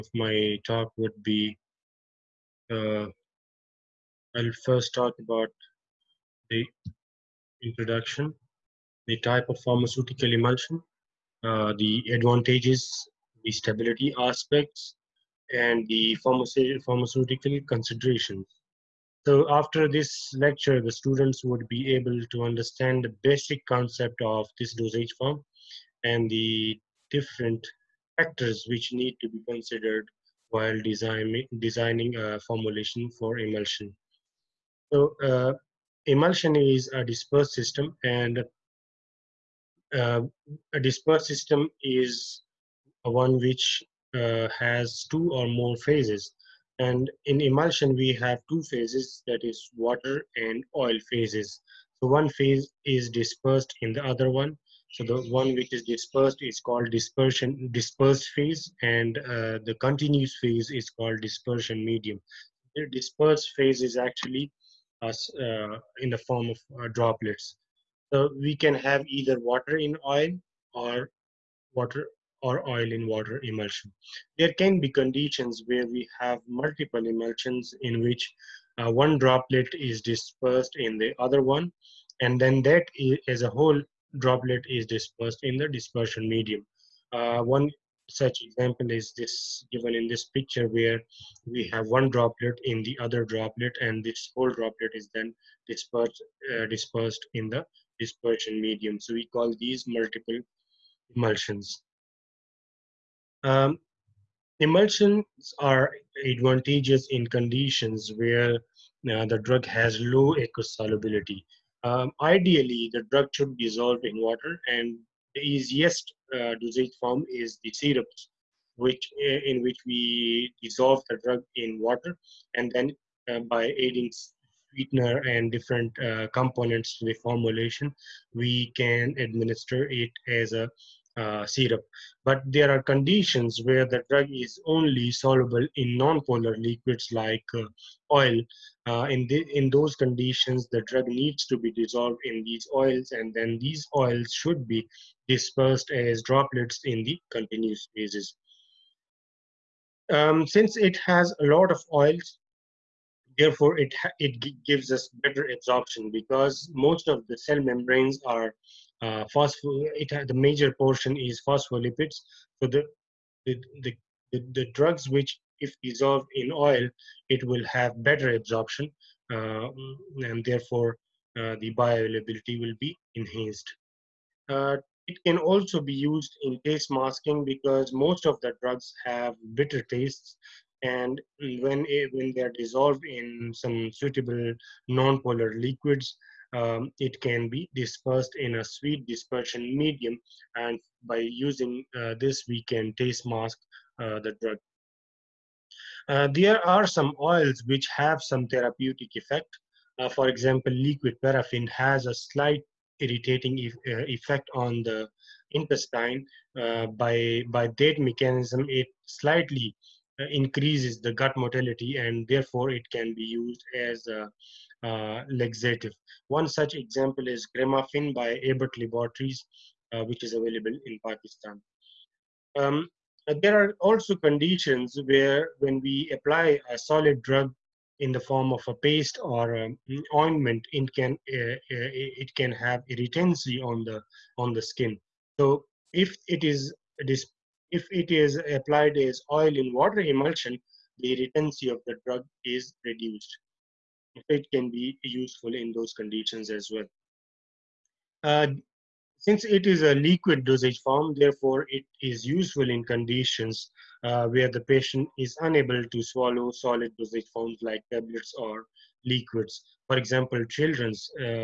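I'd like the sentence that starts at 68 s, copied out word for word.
So we can have either water in oil or water or oil in water emulsion.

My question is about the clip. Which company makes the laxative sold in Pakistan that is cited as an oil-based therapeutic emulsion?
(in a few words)
Abbott Laboratories.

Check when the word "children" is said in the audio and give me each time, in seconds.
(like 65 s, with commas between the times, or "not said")
260 s.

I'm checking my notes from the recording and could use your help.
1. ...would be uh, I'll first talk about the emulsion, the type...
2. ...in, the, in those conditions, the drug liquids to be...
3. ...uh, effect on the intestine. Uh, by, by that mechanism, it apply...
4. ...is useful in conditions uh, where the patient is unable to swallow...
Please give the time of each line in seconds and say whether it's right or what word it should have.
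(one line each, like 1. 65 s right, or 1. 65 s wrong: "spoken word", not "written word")
1. 0 s wrong: "introduction", not "emulsion"
2. 139 s wrong: "needs", not "liquids"
3. 203 s wrong: "slightly", not "apply"
4. 252 s right.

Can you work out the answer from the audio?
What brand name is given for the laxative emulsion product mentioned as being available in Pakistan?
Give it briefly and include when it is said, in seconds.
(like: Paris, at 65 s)
Cremaffin, at 217 s.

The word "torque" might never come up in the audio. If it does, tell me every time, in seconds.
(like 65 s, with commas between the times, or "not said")
not said.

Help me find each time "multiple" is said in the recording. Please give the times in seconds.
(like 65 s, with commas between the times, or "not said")
76 s, 99 s.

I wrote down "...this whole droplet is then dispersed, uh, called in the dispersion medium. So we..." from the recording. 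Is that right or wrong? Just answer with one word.
wrong.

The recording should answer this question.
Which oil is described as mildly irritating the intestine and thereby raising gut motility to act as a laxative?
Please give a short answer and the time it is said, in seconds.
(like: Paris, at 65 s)
liquid paraffin, at 200 s.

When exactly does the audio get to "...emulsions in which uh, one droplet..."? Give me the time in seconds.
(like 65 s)
77 s.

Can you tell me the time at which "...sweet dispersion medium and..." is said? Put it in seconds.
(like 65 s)
188 s.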